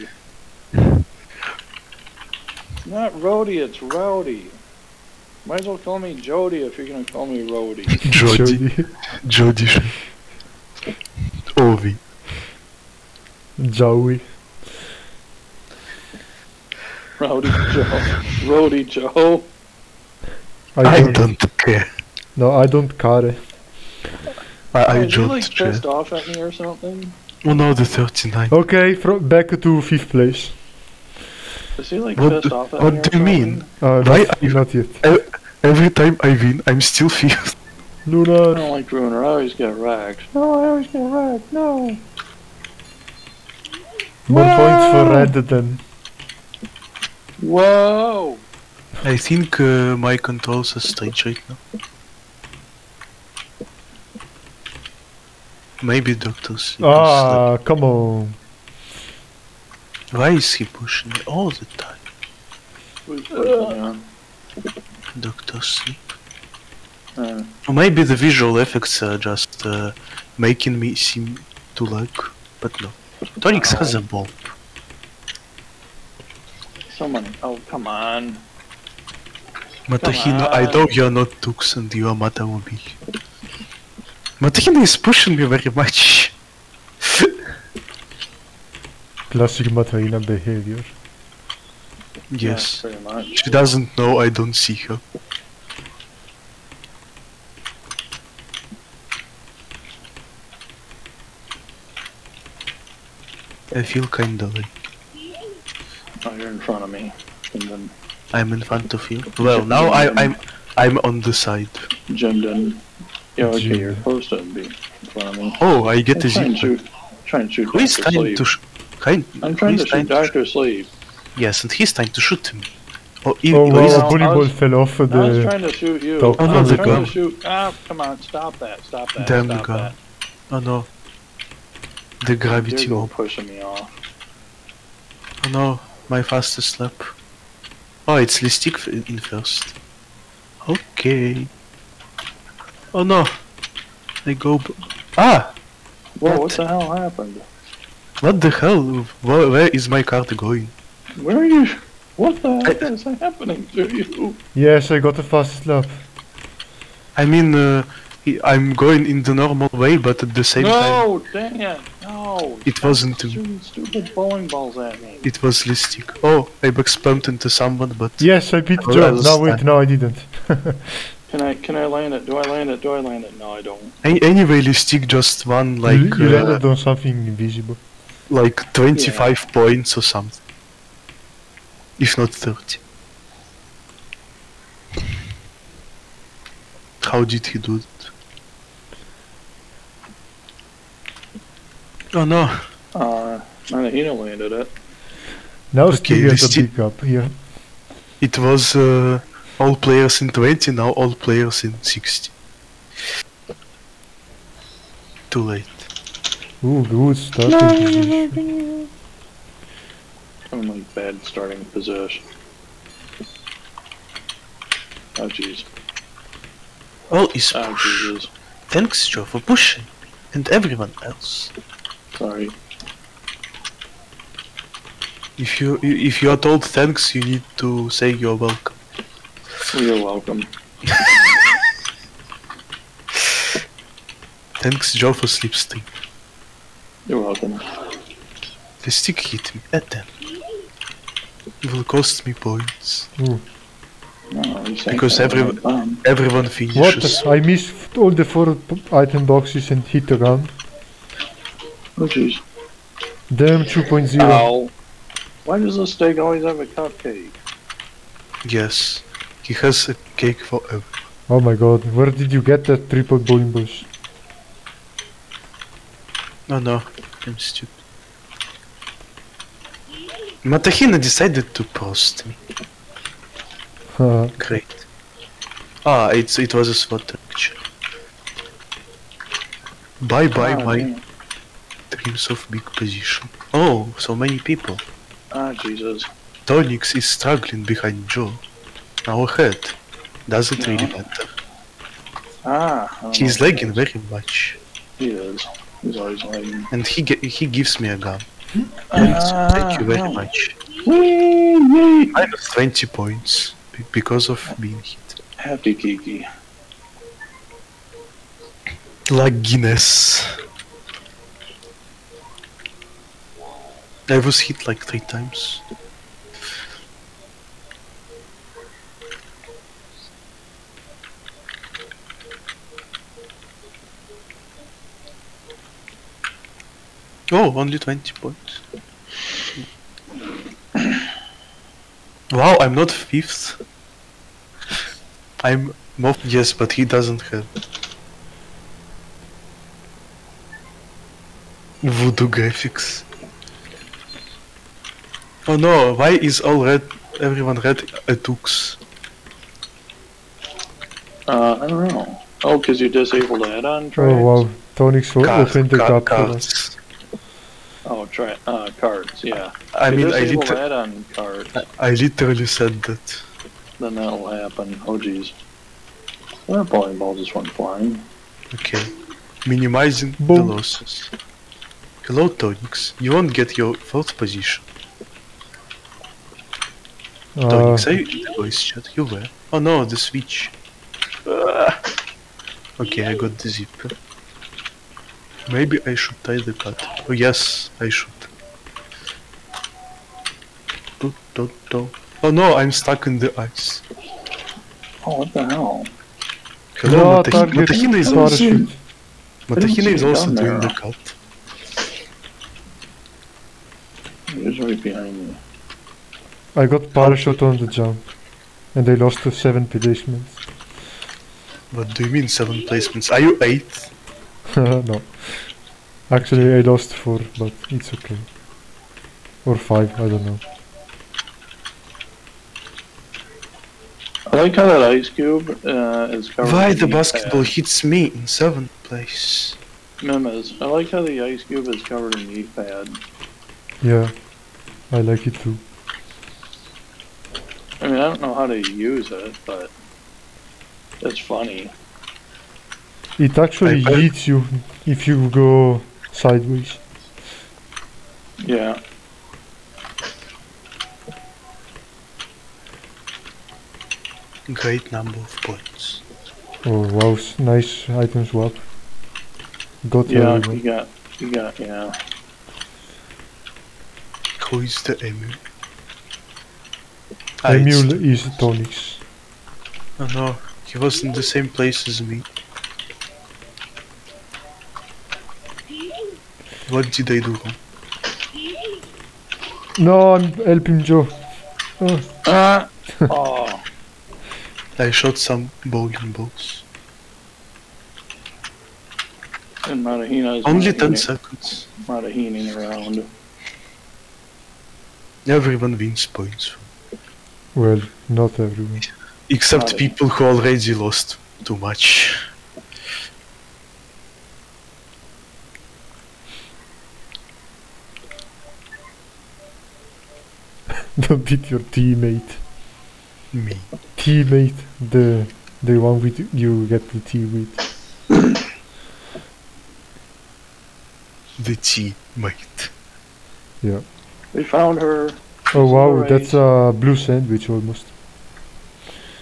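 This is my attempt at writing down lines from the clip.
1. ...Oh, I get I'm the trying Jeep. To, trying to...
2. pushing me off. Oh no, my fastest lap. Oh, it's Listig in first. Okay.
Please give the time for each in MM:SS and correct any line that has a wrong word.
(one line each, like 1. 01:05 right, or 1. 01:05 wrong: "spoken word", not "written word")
1. 01:55 right
2. 02:13 right.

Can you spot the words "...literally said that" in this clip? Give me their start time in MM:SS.
06:01.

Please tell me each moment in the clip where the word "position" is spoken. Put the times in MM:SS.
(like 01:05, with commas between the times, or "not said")
03:31, 04:42, 06:14.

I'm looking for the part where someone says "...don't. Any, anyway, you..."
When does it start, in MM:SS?
02:53.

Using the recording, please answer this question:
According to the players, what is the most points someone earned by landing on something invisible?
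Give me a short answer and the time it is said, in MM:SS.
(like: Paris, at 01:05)
30, at 03:02.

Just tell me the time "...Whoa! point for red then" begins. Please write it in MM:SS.
00:44.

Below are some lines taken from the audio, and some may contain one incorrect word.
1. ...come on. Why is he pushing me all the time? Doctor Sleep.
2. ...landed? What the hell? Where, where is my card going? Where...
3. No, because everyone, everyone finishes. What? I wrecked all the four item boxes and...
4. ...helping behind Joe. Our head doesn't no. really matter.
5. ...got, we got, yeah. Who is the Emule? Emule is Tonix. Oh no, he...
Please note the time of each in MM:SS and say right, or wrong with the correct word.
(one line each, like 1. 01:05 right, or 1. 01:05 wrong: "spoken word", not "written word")
1. 00:57 right
2. 02:26 wrong: "happened", not "landed"
3. 04:04 wrong: "missed", not "wrecked"
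4. 04:47 wrong: "struggling", not "helping"
5. 07:40 right.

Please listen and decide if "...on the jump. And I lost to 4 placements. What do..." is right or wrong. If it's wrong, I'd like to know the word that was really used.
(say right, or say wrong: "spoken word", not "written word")
wrong: "7", not "4".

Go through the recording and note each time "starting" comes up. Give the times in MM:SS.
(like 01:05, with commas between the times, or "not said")
03:27, 03:31.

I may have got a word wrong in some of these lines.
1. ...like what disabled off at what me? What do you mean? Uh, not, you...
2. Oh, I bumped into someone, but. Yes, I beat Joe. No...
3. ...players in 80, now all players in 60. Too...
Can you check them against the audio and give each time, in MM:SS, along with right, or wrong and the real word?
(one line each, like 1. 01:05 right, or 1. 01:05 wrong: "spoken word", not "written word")
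1. 00:31 wrong: "pissed", not "disabled"
2. 02:46 right
3. 03:19 wrong: "20", not "80".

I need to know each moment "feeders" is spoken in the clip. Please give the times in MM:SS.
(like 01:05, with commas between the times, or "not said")
not said.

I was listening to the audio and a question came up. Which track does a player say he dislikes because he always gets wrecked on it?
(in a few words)
Ruiner.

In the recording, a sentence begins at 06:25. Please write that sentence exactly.
Maybe I should tie the cat.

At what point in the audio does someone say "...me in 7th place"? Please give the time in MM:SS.
07:07.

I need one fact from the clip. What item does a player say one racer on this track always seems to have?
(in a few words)
a cupcake.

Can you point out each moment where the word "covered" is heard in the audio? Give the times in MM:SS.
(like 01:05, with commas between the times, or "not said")
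07:06, 07:11.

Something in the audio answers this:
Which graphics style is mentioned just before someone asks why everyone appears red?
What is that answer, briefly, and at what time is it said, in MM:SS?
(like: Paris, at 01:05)
Voodoo graphics, at 05:41.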